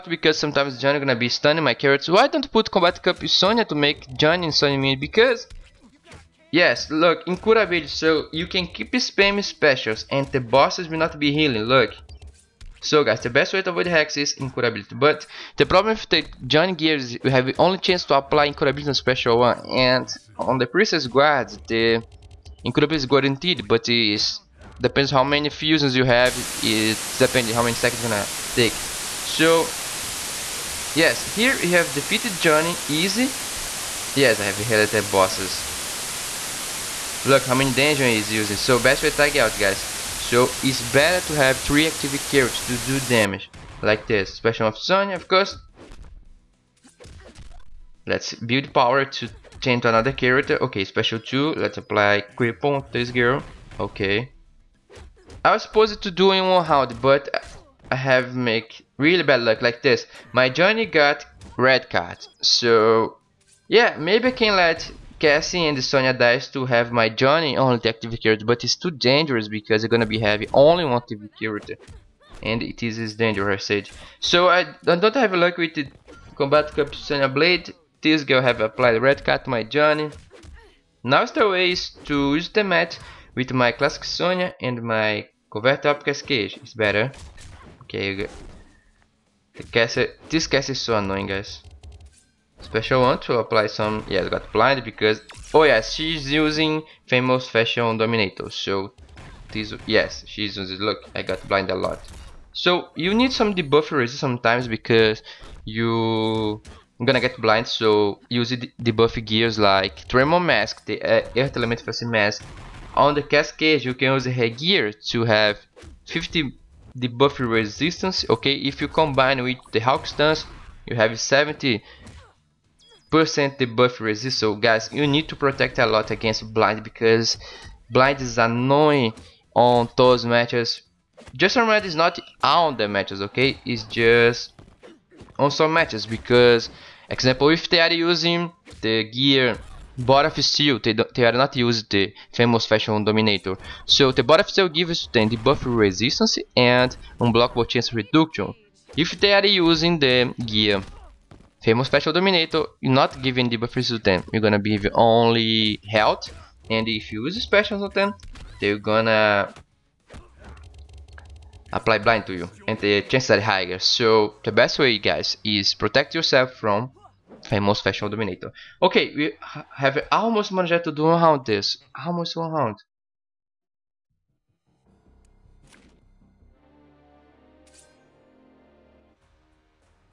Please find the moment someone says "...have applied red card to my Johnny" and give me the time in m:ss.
1:18.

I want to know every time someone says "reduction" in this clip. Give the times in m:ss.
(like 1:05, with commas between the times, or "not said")
2:27.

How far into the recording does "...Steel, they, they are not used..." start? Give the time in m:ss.
2:20.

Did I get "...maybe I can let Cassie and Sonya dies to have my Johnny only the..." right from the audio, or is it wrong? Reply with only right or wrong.
right.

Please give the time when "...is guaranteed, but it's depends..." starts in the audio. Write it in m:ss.
0:23.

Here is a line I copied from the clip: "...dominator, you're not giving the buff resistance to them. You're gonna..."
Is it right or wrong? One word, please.
right.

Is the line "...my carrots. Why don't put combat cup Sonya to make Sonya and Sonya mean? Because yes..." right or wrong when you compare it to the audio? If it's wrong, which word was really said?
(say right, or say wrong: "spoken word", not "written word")
wrong: "Johnny", not "Sonya".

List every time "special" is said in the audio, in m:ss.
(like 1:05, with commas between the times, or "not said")
0:09, 0:18, 0:44, 0:50, 1:32, 2:37.